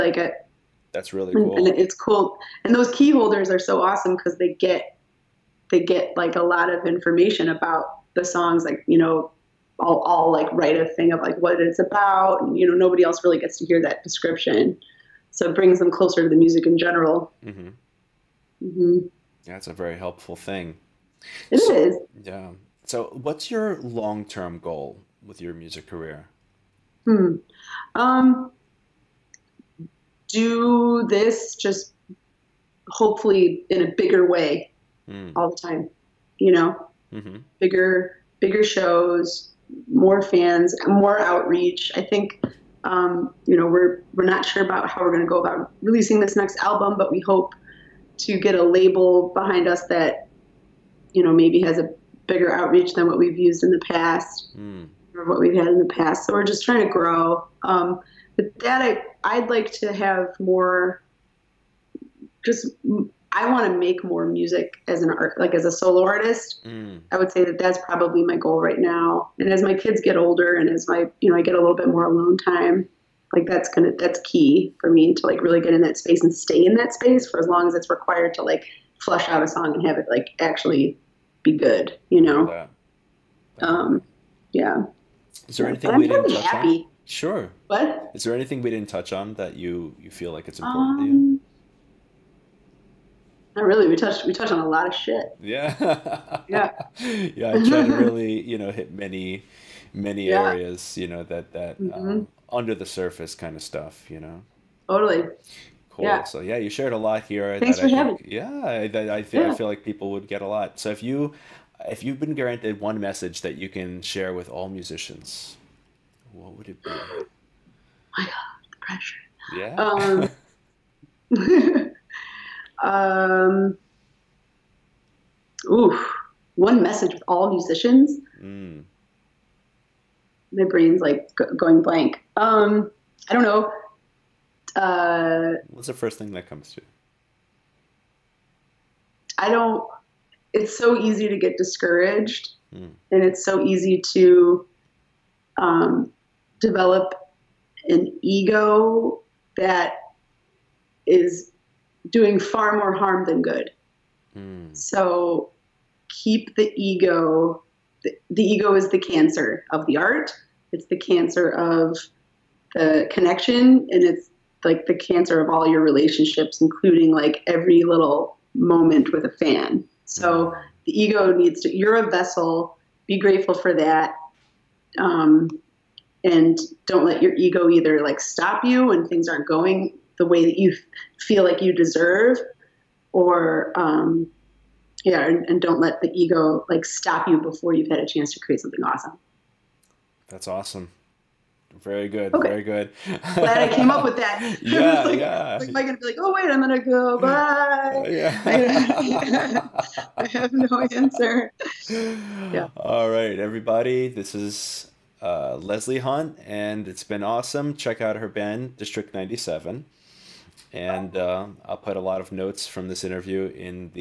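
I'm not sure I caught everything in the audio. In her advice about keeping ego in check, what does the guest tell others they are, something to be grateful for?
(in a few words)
a vessel.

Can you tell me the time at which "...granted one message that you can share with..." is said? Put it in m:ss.
1:52.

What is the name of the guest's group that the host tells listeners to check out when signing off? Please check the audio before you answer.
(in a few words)
District 97.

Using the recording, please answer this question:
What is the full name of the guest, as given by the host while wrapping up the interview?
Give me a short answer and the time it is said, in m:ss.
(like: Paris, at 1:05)
Leslie Hunt, at 3:25.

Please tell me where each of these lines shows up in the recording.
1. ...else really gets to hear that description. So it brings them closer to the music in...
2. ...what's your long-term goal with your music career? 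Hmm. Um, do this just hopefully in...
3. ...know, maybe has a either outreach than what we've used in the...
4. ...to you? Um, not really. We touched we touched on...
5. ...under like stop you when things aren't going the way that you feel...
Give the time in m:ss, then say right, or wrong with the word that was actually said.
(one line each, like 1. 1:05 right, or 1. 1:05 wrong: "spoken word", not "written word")
1. 0:13 right
2. 0:23 right
3. 0:51 wrong: "bigger", not "either"
4. 1:30 right
5. 2:57 wrong: "either", not "under".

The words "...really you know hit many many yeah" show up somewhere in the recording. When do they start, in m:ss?
1:37.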